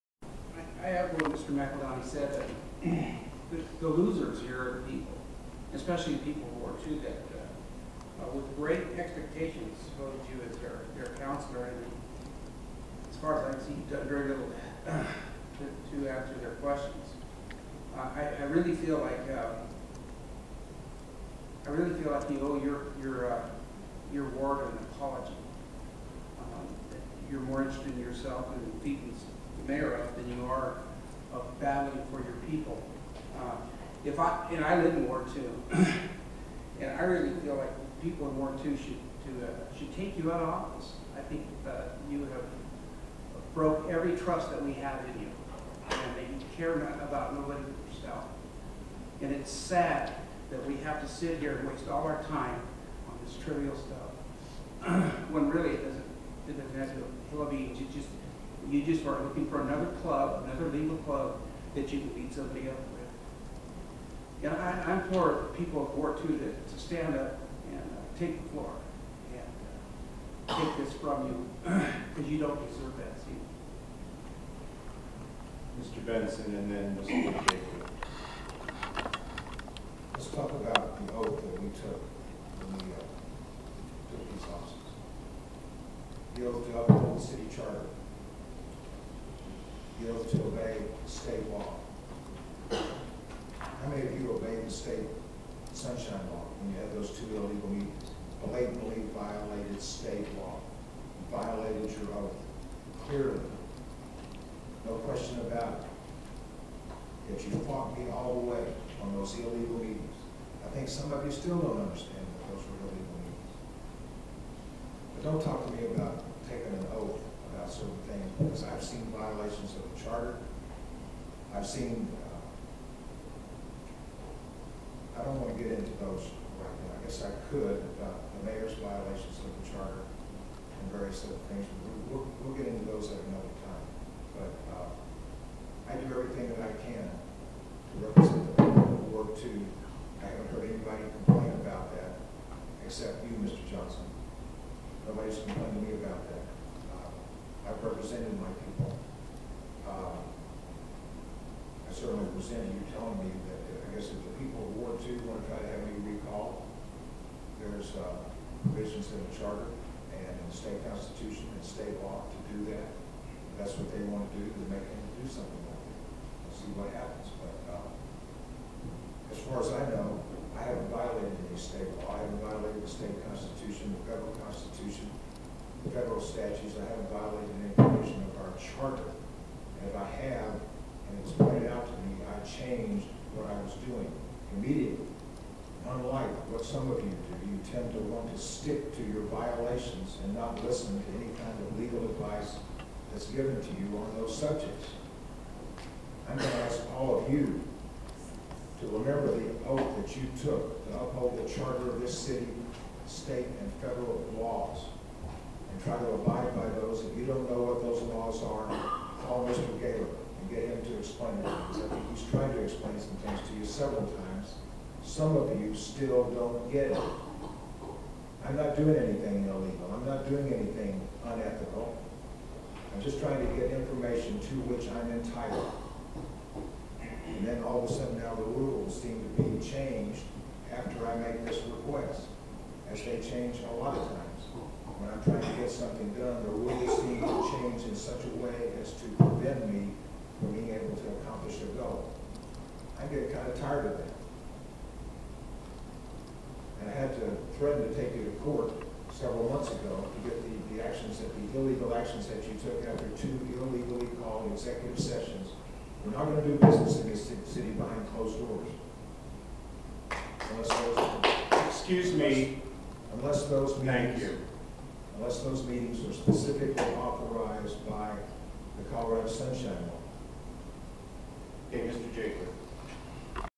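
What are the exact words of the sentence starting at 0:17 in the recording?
Uh, I, I really feel like um, I really feel like you owe your your uh, your ward an apology.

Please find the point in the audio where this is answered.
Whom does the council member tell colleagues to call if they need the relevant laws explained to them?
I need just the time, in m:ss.
3:29.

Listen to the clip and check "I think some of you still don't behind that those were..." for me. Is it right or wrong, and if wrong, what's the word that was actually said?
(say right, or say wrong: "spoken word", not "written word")
wrong: "understand", not "behind".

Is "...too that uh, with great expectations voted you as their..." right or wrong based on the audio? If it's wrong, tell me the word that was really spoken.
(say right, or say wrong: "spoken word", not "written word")
right.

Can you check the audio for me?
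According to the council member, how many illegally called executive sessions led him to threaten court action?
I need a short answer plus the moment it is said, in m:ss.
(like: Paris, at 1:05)
2, at 4:13.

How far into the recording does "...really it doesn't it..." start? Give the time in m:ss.
0:55.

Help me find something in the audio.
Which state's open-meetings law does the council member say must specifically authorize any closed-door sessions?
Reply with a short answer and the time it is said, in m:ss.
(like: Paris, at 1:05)
Colorado, at 4:28.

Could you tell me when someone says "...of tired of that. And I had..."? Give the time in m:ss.
4:03.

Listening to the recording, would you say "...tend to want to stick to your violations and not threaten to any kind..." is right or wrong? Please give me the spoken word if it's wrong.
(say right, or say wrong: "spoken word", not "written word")
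wrong: "listen", not "threaten".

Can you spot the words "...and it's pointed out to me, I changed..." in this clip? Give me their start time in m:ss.
3:00.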